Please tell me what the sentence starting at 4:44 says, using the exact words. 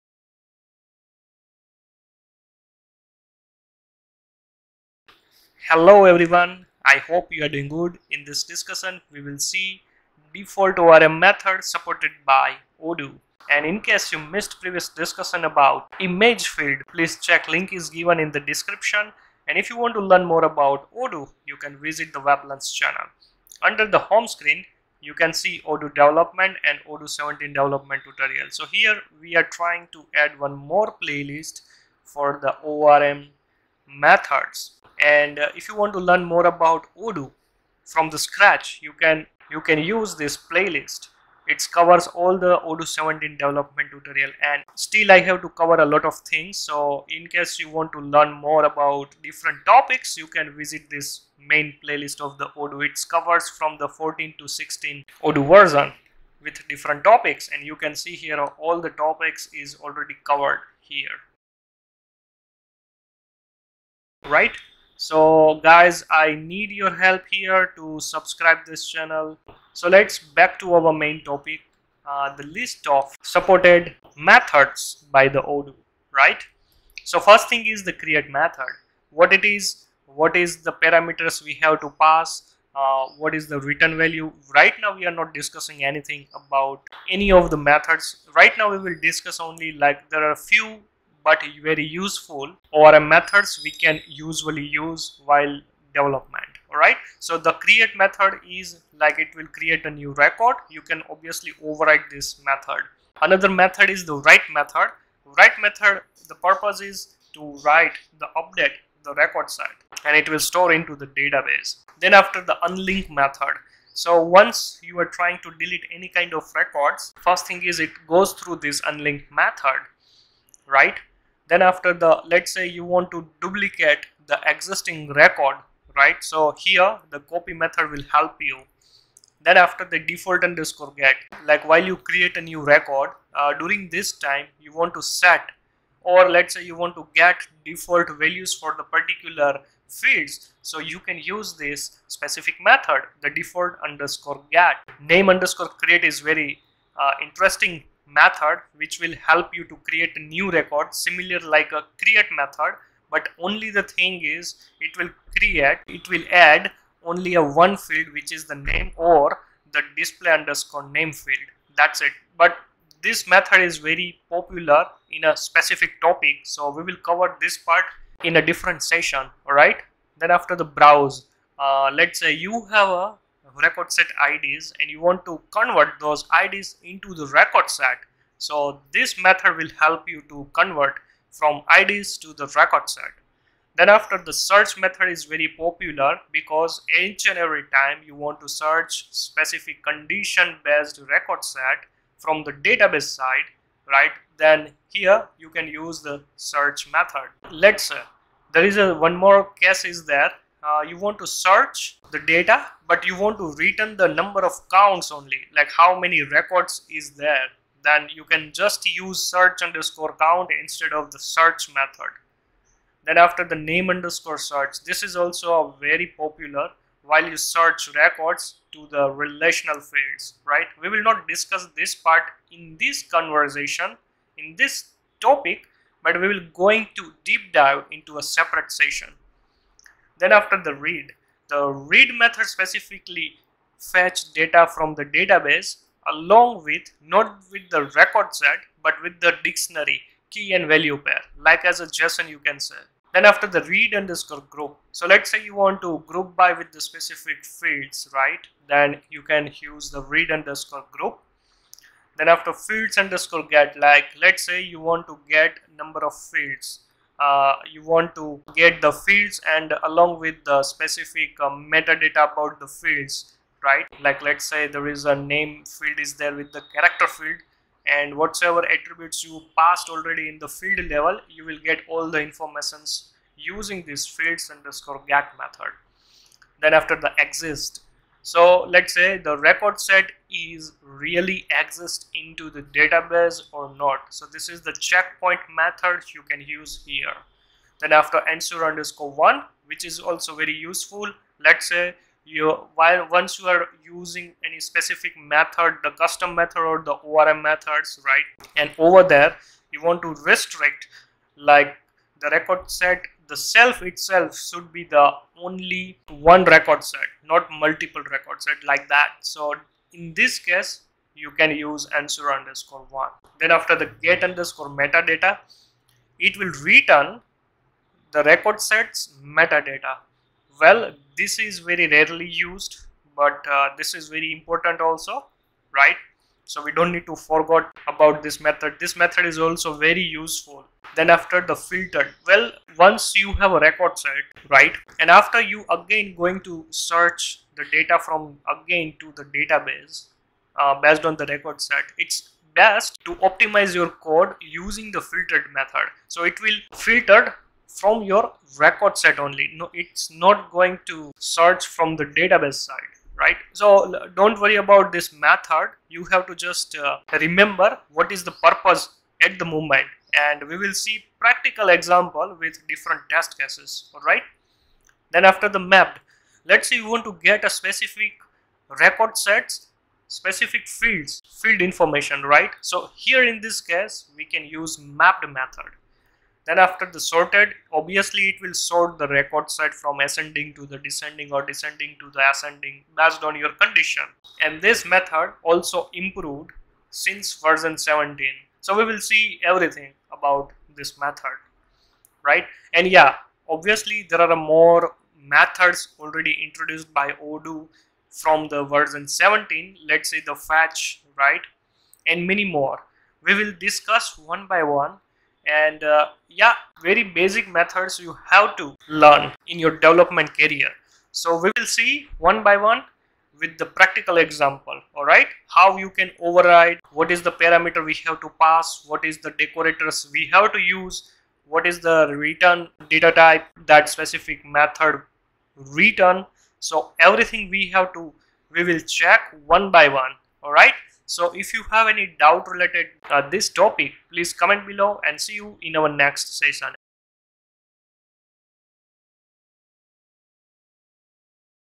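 So this is the checkpoint method you can use here.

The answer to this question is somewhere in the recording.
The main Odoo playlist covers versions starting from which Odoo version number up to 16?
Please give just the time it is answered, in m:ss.
0:53.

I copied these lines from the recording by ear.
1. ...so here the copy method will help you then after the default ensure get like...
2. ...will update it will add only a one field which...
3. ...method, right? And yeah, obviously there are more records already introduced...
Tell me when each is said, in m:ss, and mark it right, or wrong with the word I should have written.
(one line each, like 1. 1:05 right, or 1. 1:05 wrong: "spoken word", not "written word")
1. 2:06 wrong: "underscore", not "ensure"
2. 2:34 wrong: "create", not "update"
3. 6:30 wrong: "methods", not "records".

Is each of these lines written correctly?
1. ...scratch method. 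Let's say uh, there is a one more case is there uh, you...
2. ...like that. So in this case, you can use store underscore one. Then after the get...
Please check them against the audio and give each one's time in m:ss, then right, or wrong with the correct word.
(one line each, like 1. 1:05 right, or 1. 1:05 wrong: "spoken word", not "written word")
1. 3:16 wrong: "search", not "scratch"
2. 5:08 wrong: "ensure", not "store".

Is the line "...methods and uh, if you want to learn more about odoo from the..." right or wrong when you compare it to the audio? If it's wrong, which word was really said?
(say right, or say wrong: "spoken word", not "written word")
right.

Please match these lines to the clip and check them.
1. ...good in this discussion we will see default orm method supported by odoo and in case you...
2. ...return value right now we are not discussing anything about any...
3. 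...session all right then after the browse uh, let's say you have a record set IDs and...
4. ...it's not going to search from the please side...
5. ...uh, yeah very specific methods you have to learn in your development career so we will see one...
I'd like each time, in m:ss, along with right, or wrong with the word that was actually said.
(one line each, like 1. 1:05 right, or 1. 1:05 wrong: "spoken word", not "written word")
1. 0:07 right
2. 1:23 right
3. 2:48 right
4. 5:49 wrong: "database", not "please"
5. 6:45 wrong: "basic", not "specific".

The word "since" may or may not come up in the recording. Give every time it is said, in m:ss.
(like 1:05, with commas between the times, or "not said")
6:26.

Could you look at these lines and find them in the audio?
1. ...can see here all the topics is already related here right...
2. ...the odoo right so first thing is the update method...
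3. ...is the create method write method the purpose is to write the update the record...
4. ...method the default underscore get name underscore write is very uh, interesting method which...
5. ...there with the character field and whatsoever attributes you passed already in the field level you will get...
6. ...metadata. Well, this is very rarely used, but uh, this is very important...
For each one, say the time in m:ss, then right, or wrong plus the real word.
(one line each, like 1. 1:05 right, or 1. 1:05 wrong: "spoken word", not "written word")
1. 0:57 wrong: "covered", not "related"
2. 1:15 wrong: "create", not "update"
3. 1:43 wrong: "write", not "create"
4. 2:22 wrong: "create", not "write"
5. 4:26 right
6. 5:19 right.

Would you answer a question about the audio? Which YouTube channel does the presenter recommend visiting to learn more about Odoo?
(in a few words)
weblearns.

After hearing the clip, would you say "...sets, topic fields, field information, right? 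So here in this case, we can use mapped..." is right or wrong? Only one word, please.
wrong.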